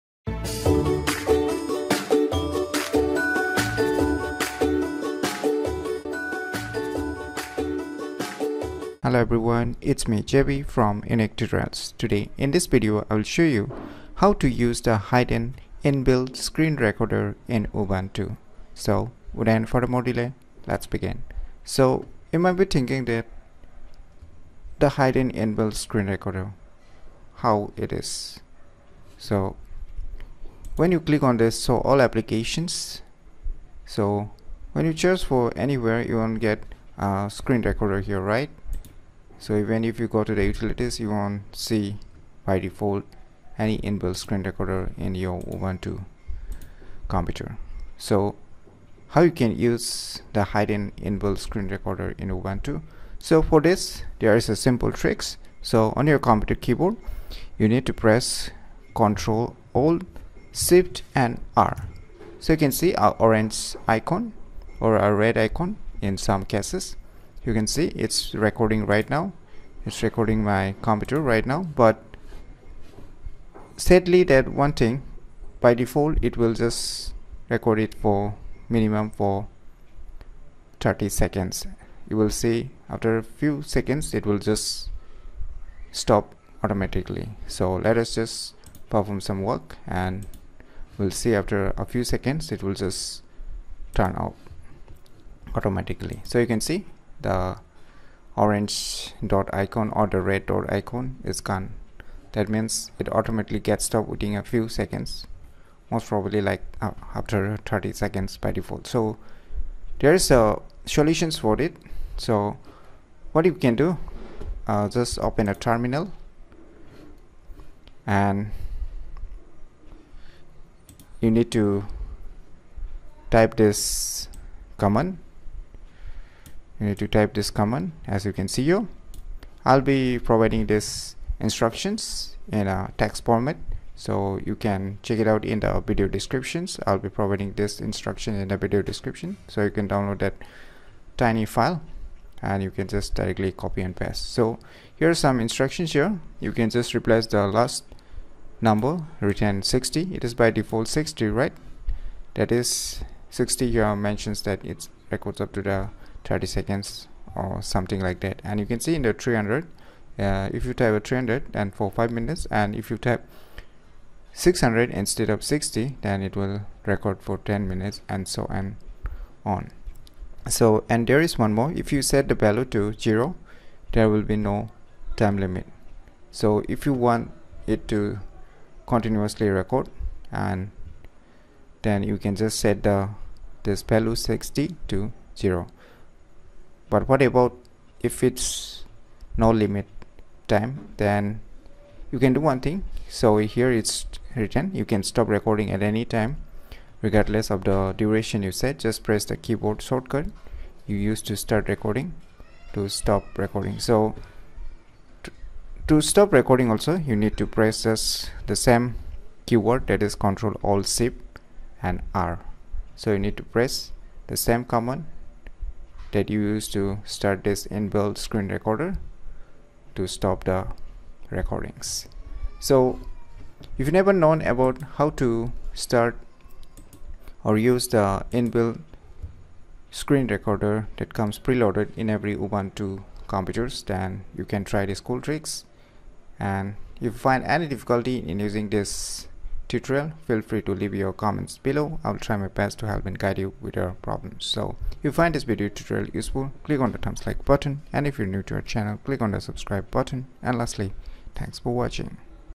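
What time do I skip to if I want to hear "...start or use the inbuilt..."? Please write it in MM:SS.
03:45.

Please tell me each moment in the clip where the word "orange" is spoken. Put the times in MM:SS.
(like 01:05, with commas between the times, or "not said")
01:03, 01:38.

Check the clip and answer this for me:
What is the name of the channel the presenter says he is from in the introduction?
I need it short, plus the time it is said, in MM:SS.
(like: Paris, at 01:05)
Unique Today, at 00:11.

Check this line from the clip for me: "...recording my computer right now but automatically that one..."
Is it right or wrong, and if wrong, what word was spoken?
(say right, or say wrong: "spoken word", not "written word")
wrong: "sadly", not "automatically".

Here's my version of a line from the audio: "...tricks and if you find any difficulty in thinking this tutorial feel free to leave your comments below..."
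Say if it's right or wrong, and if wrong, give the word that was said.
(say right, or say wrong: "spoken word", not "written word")
wrong: "using", not "thinking".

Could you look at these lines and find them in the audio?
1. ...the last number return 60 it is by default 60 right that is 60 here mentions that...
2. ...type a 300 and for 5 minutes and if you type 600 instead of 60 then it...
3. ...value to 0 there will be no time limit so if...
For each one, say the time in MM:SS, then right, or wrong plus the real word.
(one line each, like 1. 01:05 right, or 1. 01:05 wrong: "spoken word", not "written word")
1. 02:27 right
2. 02:40 right
3. 02:52 right.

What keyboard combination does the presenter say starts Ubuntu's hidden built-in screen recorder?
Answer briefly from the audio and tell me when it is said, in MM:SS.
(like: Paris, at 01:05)
Ctrl, Alt, Shift and R, at 00:58.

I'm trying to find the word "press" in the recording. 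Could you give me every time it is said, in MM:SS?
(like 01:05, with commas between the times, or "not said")
00:58, 03:19, 03:27, 03:33.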